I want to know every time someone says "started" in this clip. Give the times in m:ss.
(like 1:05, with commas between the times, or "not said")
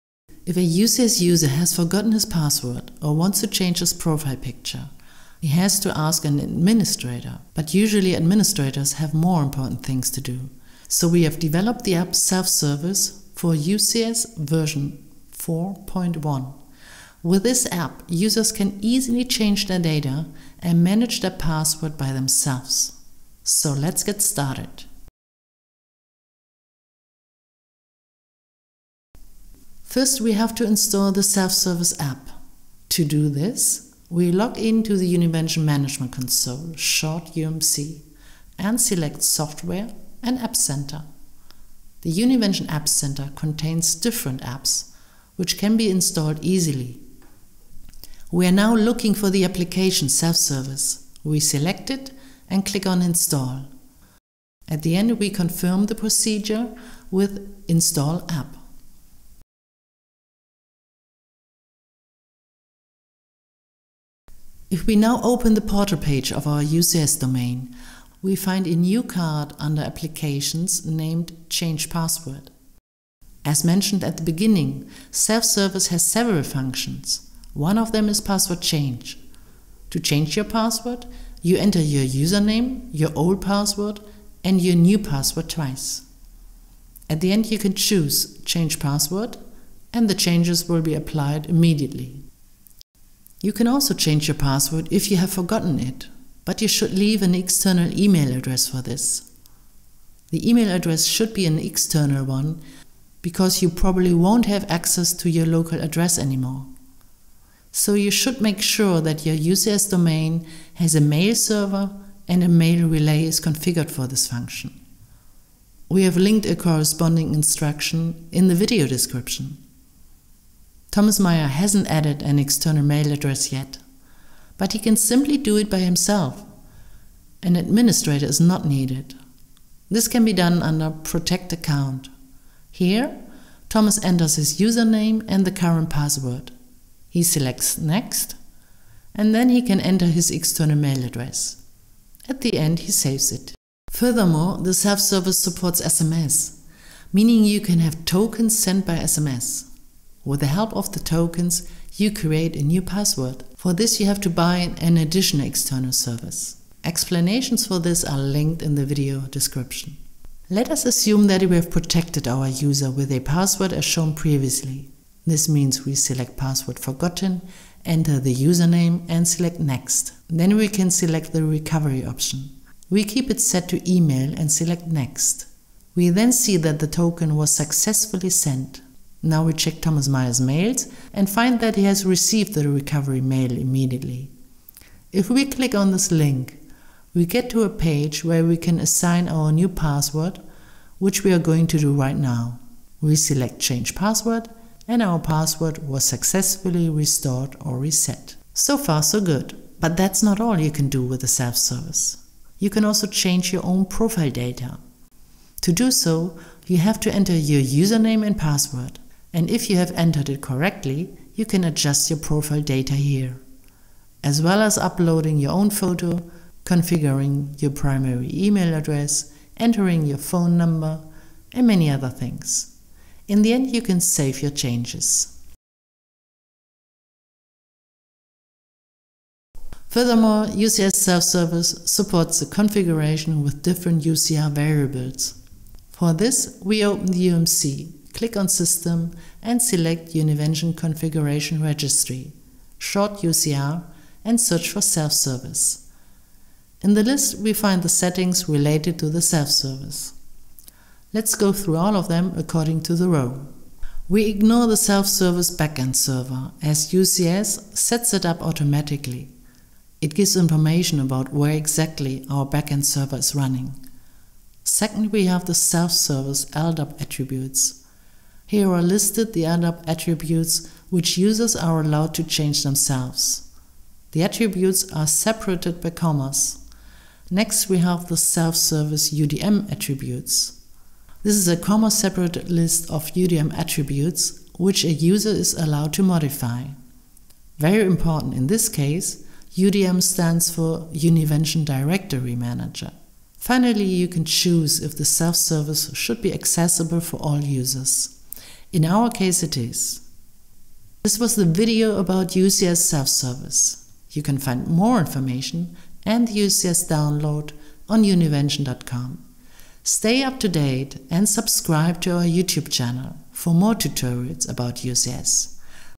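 0:24.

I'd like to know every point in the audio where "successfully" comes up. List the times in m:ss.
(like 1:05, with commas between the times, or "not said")
2:57, 3:16.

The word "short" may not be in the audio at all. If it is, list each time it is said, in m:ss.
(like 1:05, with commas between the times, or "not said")
0:36, 4:02.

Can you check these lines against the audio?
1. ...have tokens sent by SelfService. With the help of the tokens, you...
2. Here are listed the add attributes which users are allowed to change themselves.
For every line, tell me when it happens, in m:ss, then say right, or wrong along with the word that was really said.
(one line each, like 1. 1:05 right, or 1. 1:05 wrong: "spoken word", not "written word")
1. 2:27 wrong: "SMS", not "SelfService"
2. 4:28 right.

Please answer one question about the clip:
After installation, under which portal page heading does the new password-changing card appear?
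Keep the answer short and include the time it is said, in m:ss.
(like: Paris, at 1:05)
Applications, at 1:09.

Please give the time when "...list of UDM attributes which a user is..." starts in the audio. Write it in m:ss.
4:42.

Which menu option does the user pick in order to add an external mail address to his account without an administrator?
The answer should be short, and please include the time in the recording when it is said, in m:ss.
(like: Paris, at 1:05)
Protect Account, at 2:10.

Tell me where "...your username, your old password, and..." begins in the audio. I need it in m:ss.
1:21.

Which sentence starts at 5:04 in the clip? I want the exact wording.
You can find more information and UCS download on univention.com.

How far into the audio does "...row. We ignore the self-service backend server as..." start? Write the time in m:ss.
4:13.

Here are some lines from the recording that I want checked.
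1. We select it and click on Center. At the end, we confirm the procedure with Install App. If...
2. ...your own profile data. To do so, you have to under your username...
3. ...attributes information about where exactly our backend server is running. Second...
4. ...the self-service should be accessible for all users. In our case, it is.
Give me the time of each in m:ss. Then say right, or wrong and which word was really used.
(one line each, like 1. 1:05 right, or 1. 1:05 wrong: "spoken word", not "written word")
1. 0:51 wrong: "Install", not "Center"
2. 3:23 wrong: "enter", not "under"
3. 4:20 wrong: "gives", not "attributes"
4. 4:54 right.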